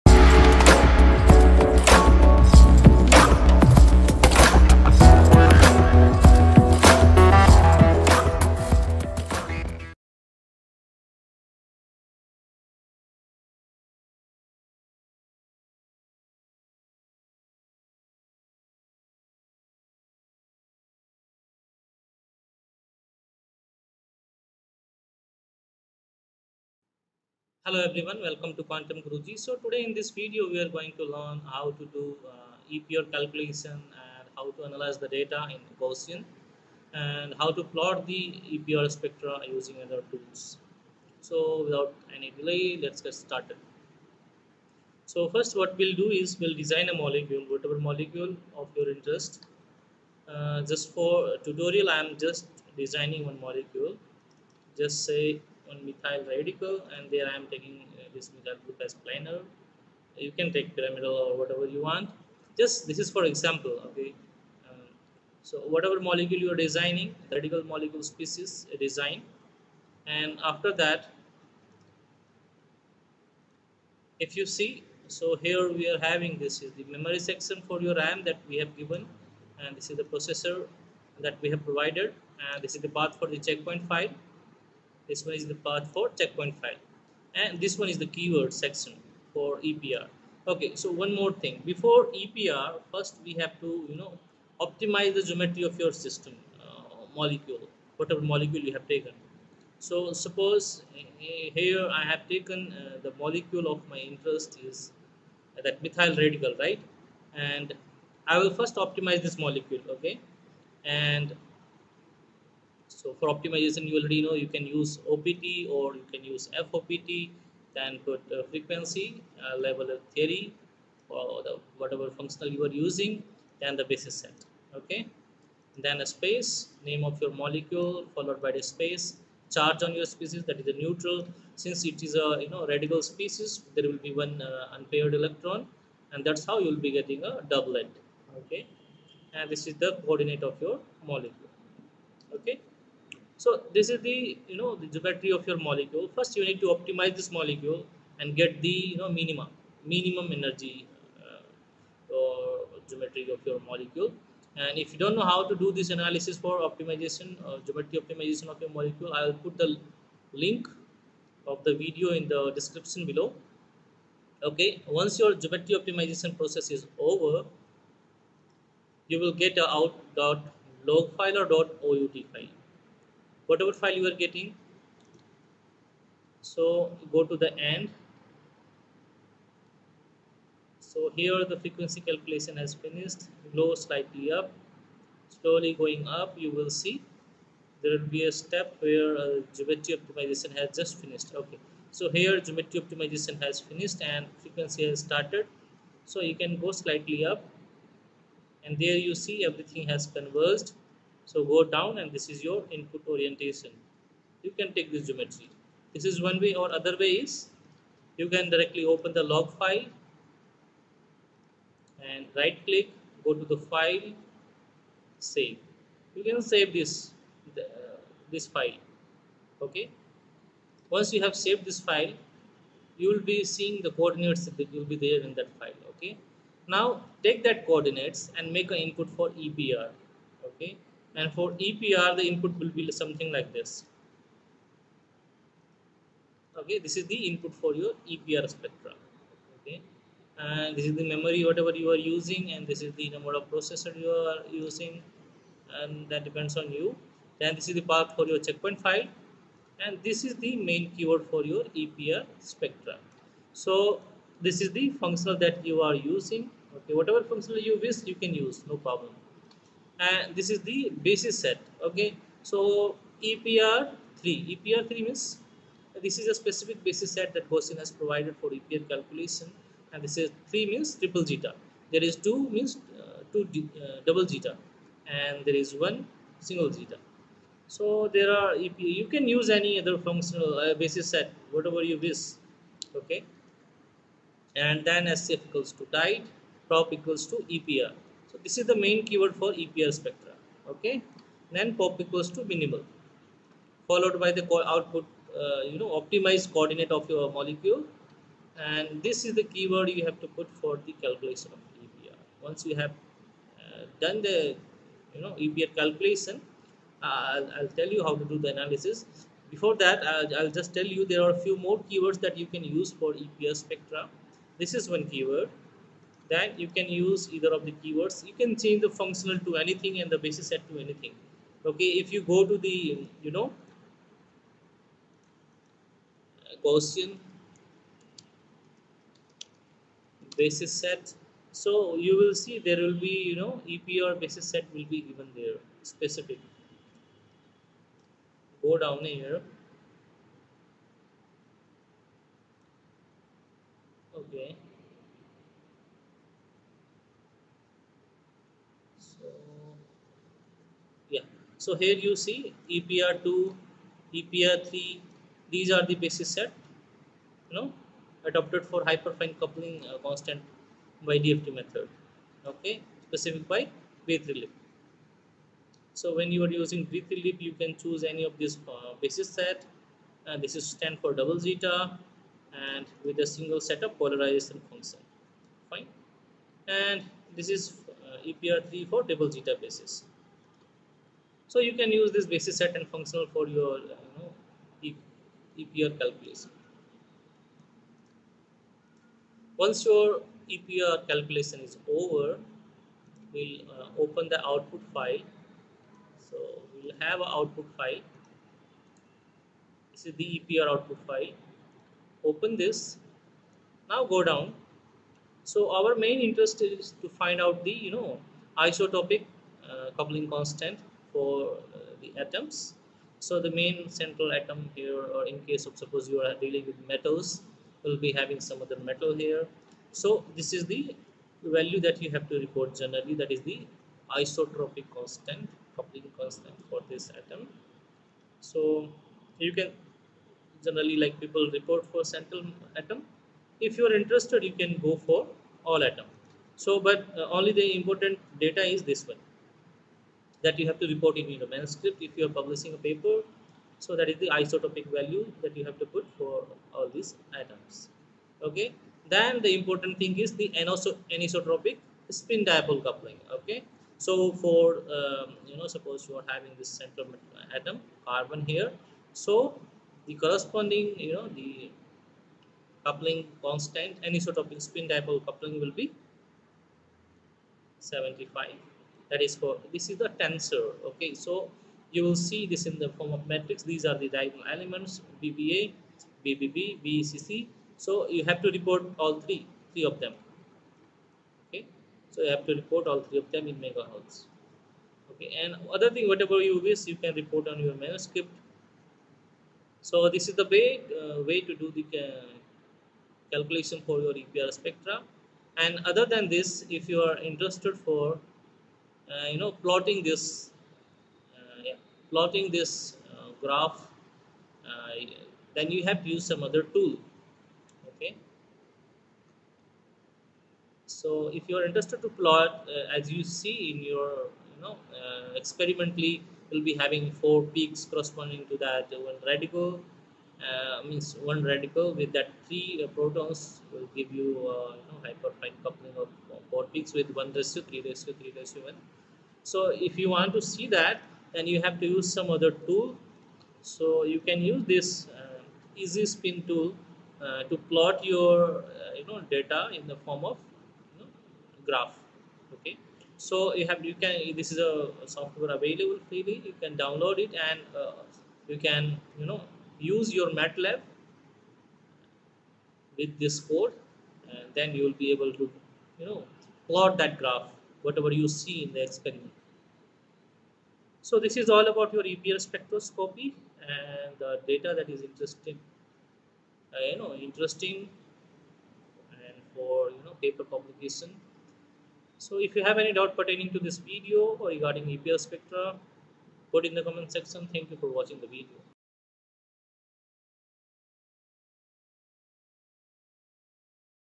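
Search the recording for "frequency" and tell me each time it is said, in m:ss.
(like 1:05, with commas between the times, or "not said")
1:58, 3:01, 3:14.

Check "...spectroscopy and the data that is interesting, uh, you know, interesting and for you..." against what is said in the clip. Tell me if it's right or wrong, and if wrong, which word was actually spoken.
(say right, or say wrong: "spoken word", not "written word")
right.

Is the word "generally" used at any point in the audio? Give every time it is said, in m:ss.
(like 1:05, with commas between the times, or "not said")
7:02, 7:10.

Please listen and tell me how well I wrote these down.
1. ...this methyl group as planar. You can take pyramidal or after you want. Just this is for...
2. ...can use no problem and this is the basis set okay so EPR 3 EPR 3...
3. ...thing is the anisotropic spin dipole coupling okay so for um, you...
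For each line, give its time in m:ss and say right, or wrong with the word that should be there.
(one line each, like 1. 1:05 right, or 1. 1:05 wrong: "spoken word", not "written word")
1. 0:58 wrong: "whatever", not "after"
2. 4:18 right
3. 7:29 right.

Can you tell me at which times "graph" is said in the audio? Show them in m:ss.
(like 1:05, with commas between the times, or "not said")
8:23, 9:01, 9:17.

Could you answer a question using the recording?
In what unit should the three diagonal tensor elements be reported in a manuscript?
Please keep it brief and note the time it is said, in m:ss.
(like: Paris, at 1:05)
megahertz, at 8:03.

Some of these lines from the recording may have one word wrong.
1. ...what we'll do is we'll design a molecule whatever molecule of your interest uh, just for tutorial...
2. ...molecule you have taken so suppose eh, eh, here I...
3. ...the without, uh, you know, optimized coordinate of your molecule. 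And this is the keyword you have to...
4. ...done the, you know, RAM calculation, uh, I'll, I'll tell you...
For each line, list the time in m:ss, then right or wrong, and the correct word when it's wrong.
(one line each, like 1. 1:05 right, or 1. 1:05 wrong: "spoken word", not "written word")
1. 0:45 right
2. 1:38 right
3. 4:54 wrong: "output", not "without"
4. 5:03 wrong: "EPR", not "RAM".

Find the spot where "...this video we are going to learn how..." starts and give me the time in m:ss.
0:29.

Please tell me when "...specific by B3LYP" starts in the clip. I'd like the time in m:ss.
6:03.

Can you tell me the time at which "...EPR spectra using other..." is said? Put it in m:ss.
0:38.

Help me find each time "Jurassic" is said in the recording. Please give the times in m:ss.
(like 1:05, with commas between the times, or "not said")
not said.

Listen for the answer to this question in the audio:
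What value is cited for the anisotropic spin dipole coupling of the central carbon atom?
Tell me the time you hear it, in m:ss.
7:47.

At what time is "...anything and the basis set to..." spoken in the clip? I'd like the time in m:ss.
5:19.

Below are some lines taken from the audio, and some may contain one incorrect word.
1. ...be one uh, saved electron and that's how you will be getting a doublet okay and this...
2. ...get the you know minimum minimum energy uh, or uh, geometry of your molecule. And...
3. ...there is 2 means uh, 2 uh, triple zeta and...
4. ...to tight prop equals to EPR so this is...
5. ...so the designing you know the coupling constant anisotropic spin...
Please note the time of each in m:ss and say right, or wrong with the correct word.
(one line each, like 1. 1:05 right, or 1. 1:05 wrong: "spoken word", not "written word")
1. 2:14 wrong: "unpaired", not "saved"
2. 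2:28 right
3. 4:31 wrong: "double", not "triple"
4. 4:45 right
5. 7:39 wrong: "corresponding", not "designing".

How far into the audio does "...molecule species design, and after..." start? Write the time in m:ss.
1:07.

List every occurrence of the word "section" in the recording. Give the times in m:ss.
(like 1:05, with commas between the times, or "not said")
1:17, 1:28, 9:37.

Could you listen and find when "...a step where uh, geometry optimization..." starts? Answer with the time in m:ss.
3:08.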